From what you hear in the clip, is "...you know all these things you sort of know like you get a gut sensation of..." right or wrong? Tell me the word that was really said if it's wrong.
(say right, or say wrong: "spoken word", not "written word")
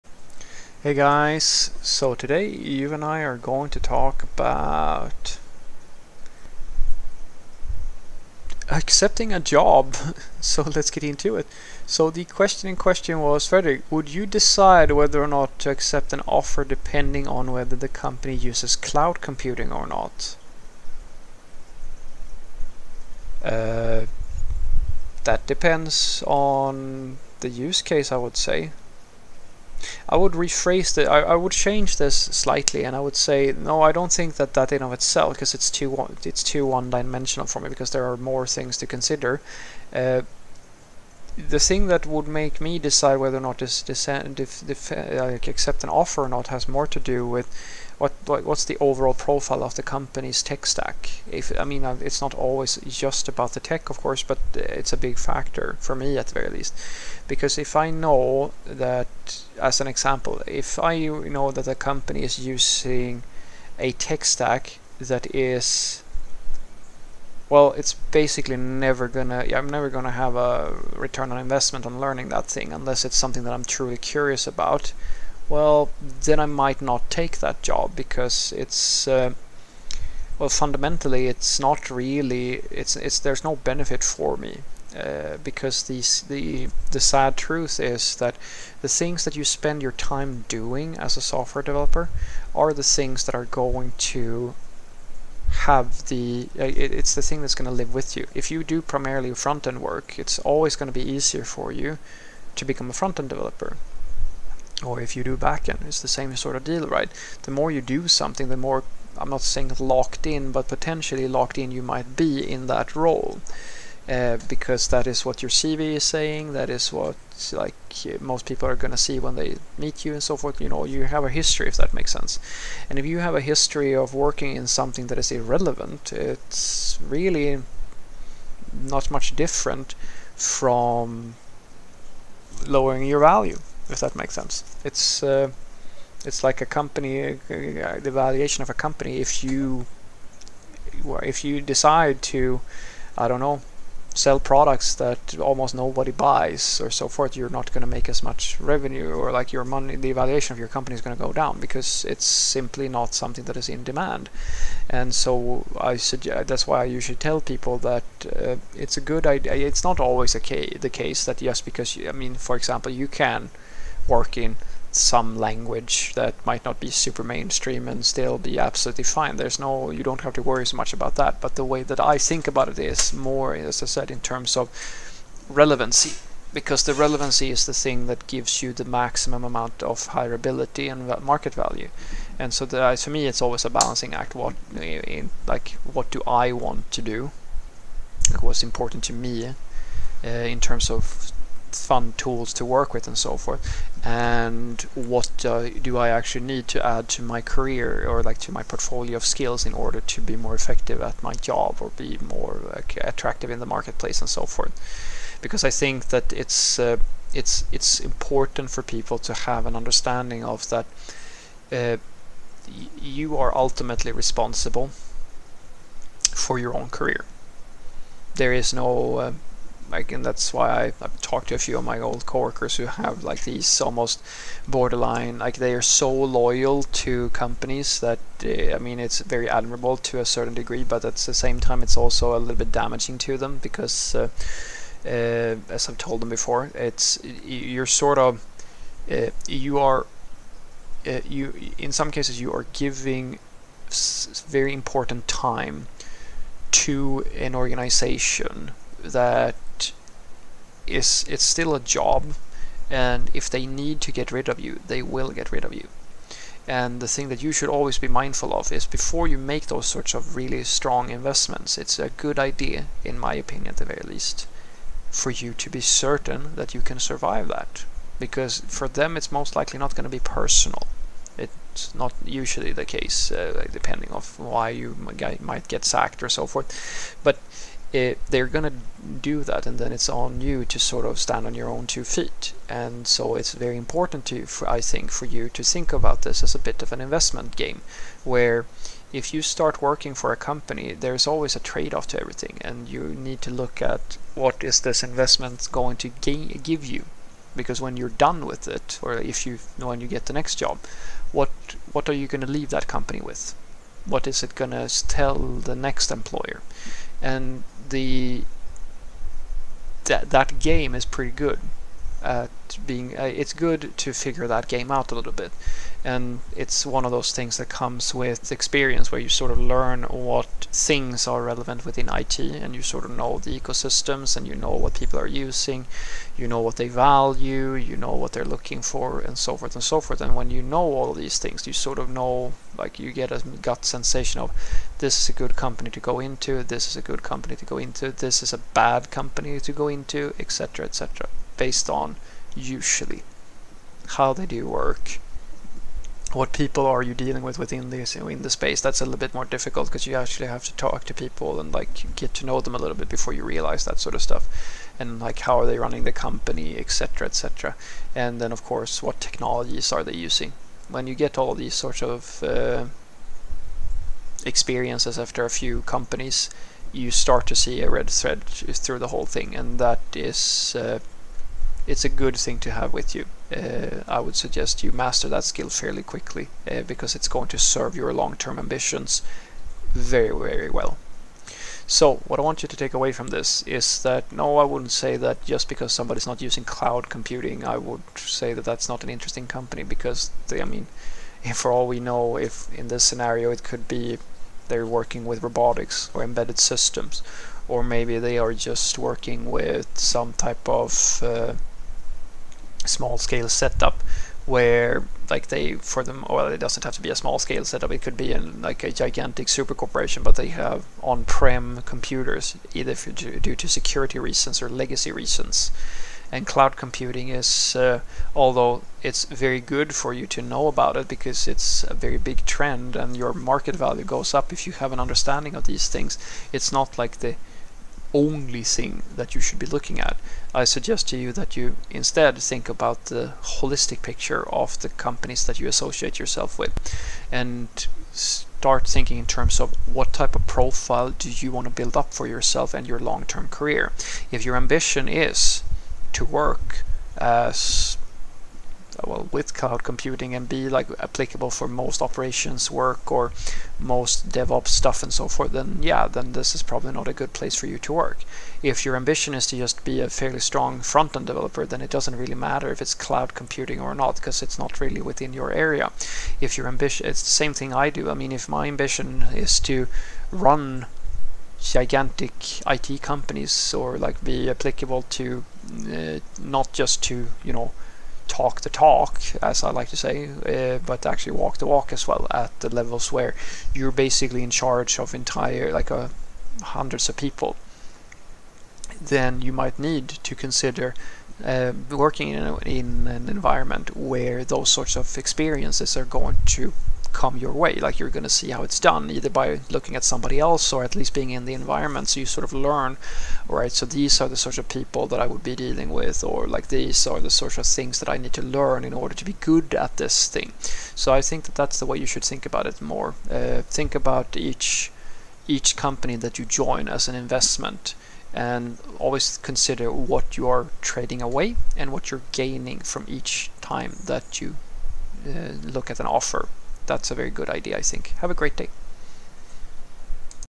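right.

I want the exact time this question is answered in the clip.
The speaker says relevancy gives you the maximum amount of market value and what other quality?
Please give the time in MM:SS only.
03:00.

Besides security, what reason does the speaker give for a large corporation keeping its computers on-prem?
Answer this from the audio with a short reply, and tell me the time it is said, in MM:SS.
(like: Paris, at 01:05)
legacy reasons, at 06:54.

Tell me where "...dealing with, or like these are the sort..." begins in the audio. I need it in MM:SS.
08:25.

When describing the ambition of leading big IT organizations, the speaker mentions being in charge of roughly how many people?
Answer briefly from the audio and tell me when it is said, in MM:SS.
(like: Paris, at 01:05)
hundreds, at 08:06.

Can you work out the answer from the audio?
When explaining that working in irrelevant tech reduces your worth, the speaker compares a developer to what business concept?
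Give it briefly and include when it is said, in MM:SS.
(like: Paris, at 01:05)
the valuation of a company, at 02:17.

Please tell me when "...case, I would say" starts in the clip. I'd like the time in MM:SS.
00:27.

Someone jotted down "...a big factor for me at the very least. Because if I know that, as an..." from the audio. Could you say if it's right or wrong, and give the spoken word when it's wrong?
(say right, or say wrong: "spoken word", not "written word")
right.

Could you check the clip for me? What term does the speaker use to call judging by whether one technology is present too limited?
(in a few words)
one-dimensional.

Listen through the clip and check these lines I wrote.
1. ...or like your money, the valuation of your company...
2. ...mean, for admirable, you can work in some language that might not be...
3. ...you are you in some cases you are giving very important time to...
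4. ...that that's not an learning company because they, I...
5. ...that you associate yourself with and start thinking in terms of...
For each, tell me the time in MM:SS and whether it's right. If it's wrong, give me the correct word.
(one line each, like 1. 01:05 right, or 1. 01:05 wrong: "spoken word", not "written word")
1. 02:29 right
2. 02:42 wrong: "example", not "admirable"
3. 03:59 right
4. 06:28 wrong: "interesting", not "learning"
5. 07:15 right.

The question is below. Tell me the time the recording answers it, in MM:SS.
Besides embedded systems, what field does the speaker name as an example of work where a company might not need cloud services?
06:35.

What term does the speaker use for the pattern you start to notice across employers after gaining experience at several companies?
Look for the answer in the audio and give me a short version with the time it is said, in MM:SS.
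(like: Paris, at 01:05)
red thread, at 06:07.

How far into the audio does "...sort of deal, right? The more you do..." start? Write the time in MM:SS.
01:46.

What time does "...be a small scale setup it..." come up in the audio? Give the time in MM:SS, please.
06:47.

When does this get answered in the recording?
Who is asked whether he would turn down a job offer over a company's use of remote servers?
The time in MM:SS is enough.
00:13.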